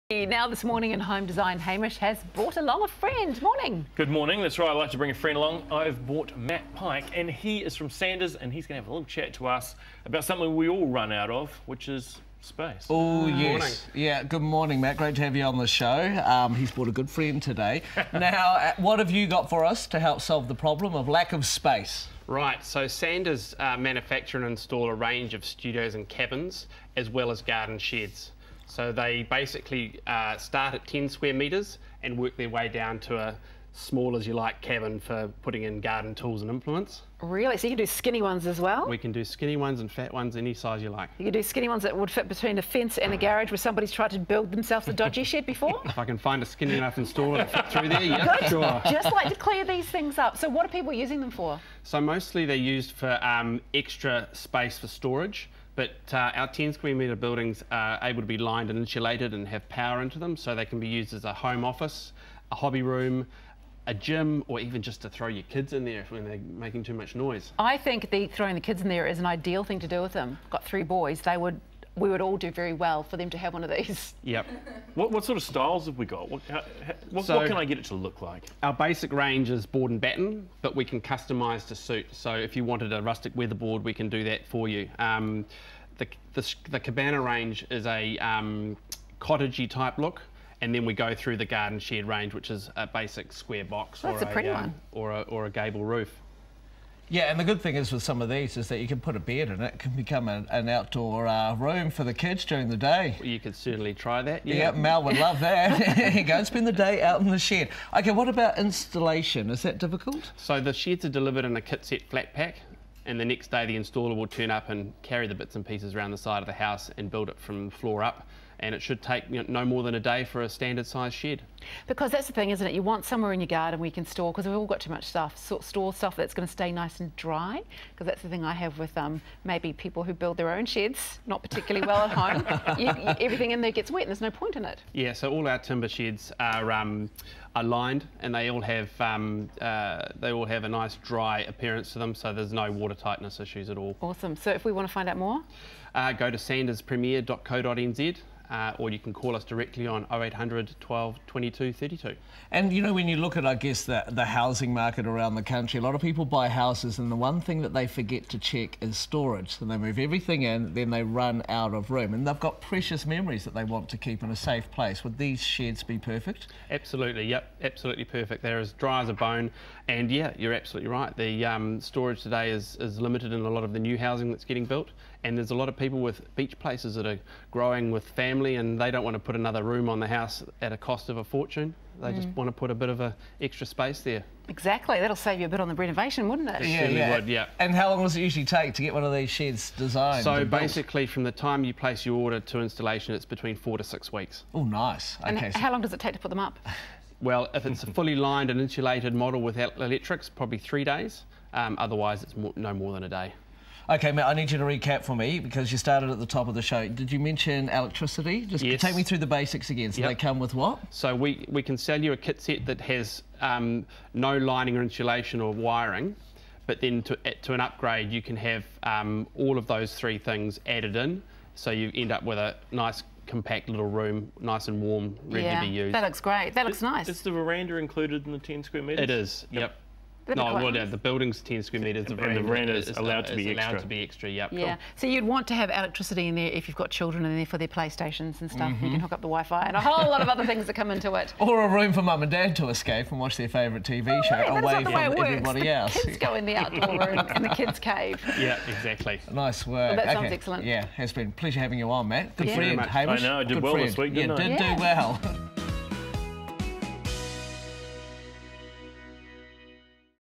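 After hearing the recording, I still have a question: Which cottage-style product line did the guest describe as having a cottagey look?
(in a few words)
cabana range.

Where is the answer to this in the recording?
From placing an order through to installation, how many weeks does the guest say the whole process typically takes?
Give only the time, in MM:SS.
03:13.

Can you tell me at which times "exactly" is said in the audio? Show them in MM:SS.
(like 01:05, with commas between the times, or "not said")
03:04, 04:08.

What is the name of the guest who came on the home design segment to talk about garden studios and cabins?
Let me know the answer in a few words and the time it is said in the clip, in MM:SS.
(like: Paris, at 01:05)
Matt Pike, at 00:06.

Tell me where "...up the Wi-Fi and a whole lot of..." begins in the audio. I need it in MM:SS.
03:59.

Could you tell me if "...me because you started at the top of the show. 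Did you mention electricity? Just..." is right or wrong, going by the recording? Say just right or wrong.
right.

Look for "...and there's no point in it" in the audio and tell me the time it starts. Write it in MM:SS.
02:14.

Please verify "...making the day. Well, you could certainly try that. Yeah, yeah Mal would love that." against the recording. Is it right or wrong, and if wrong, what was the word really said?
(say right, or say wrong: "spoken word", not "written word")
wrong: "during", not "making".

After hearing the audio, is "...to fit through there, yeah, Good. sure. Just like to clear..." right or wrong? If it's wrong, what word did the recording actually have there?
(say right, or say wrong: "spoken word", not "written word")
right.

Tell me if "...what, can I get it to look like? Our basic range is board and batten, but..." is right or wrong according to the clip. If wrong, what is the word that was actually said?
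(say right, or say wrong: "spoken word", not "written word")
right.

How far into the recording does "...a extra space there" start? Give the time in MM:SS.
03:03.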